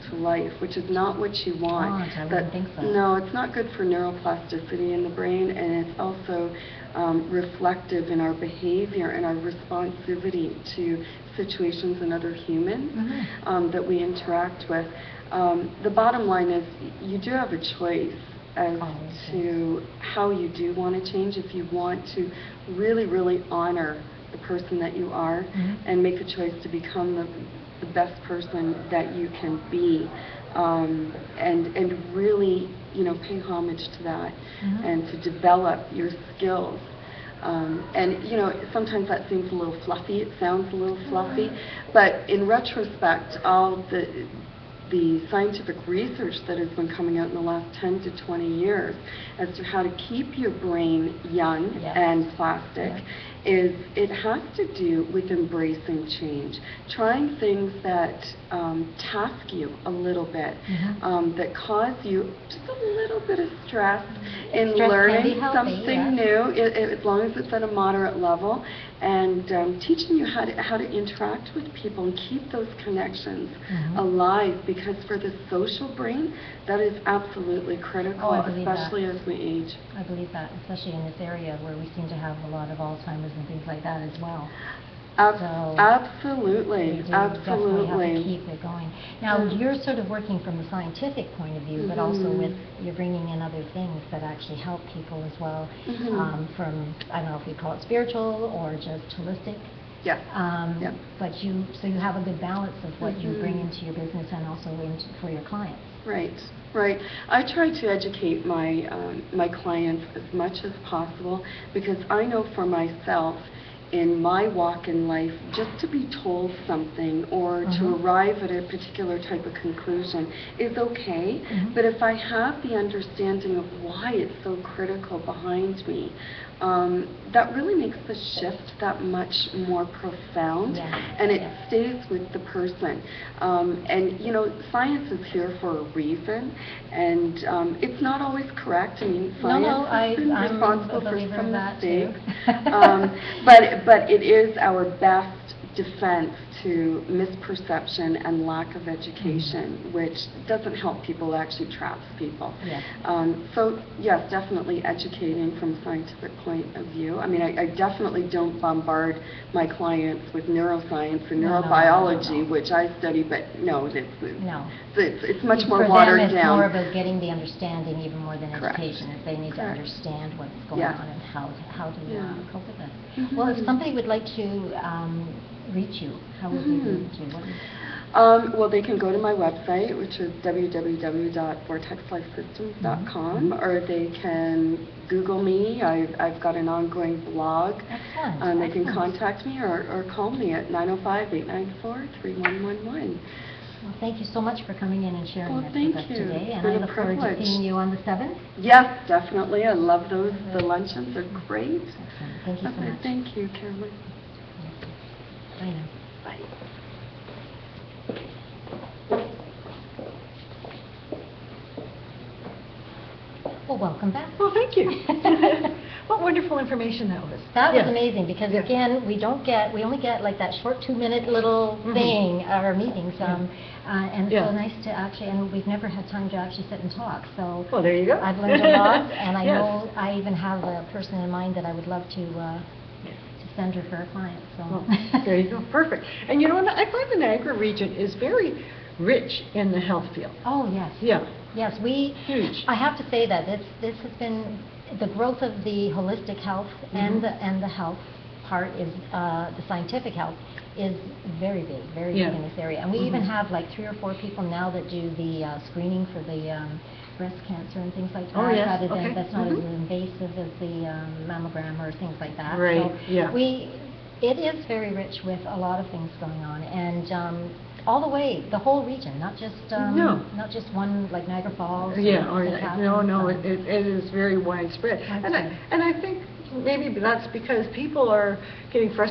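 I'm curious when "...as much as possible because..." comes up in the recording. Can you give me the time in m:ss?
1:50.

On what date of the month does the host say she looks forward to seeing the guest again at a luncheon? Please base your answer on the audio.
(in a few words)
the 7th.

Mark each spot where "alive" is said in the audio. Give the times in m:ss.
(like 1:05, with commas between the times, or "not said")
1:13.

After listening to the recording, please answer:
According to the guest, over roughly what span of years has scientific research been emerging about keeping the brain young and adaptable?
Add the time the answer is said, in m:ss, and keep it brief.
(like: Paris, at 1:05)
10 to 20 years, at 0:47.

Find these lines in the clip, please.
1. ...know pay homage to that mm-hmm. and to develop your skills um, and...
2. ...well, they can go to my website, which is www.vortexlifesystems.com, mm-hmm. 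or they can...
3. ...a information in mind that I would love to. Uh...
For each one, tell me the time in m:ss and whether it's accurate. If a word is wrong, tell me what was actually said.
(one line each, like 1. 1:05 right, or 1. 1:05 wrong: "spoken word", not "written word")
1. 0:33 right
2. 2:58 right
3. 3:50 wrong: "person", not "information".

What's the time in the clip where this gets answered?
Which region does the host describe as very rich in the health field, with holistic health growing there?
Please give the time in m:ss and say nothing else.
3:57.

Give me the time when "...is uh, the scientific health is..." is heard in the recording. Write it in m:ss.
4:08.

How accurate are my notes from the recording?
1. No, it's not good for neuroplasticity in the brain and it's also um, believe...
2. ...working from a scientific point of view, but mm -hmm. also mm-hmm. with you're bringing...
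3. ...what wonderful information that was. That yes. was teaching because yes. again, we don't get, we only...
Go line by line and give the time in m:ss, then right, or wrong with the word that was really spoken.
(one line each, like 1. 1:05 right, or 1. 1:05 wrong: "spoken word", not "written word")
1. 0:02 wrong: "reflective", not "believe"
2. 1:30 right
3. 3:36 wrong: "amazing", not "teaching".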